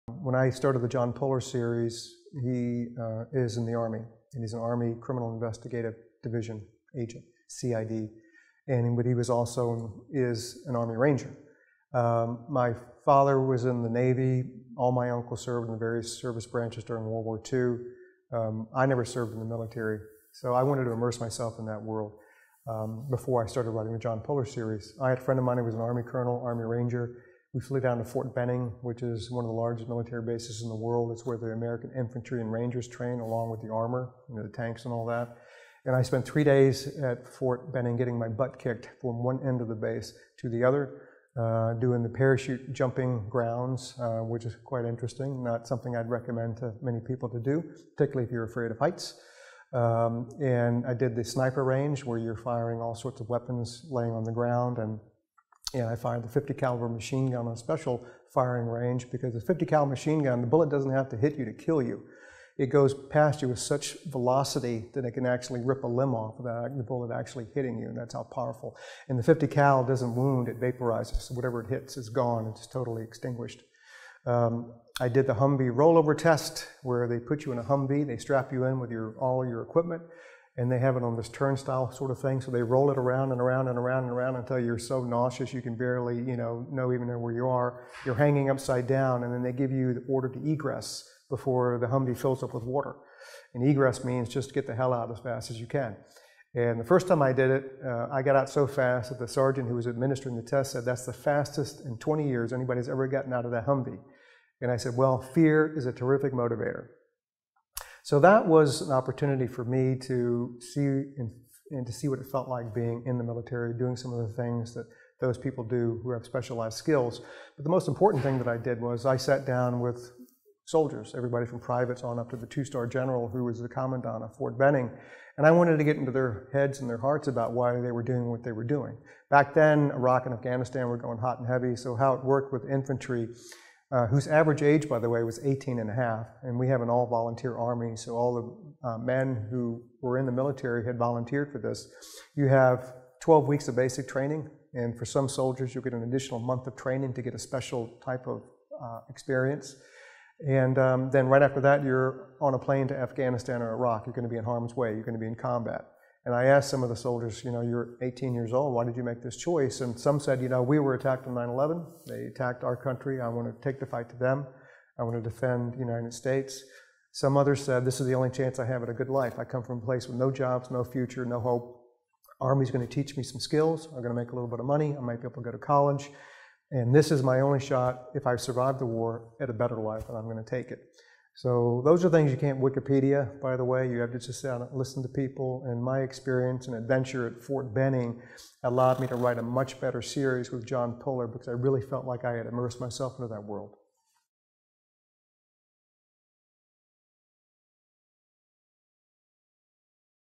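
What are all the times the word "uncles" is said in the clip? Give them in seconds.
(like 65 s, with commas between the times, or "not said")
15 s.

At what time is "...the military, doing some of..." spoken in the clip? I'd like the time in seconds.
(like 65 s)
113 s.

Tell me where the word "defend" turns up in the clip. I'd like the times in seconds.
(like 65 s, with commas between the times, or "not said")
165 s.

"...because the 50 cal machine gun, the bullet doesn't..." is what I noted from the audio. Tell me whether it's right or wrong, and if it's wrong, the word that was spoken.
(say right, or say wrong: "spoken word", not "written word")
right.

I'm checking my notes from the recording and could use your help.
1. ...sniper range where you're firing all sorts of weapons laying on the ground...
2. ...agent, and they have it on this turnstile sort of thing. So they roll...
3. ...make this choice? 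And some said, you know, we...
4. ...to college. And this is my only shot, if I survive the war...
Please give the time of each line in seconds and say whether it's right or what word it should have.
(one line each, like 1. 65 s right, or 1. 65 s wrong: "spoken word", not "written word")
1. 51 s right
2. 79 s wrong: "equipment", not "agent"
3. 159 s right
4. 175 s right.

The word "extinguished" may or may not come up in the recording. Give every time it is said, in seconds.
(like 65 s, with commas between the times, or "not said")
73 s.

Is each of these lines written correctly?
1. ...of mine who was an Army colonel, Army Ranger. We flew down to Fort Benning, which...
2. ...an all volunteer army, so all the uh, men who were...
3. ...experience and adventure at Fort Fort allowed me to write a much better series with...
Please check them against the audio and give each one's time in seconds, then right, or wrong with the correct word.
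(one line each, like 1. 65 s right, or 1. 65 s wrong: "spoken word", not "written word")
1. 25 s right
2. 136 s right
3. 186 s wrong: "Benning", not "Fort".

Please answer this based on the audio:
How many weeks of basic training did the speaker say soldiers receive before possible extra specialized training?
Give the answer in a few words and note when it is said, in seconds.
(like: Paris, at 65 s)
12, at 143 s.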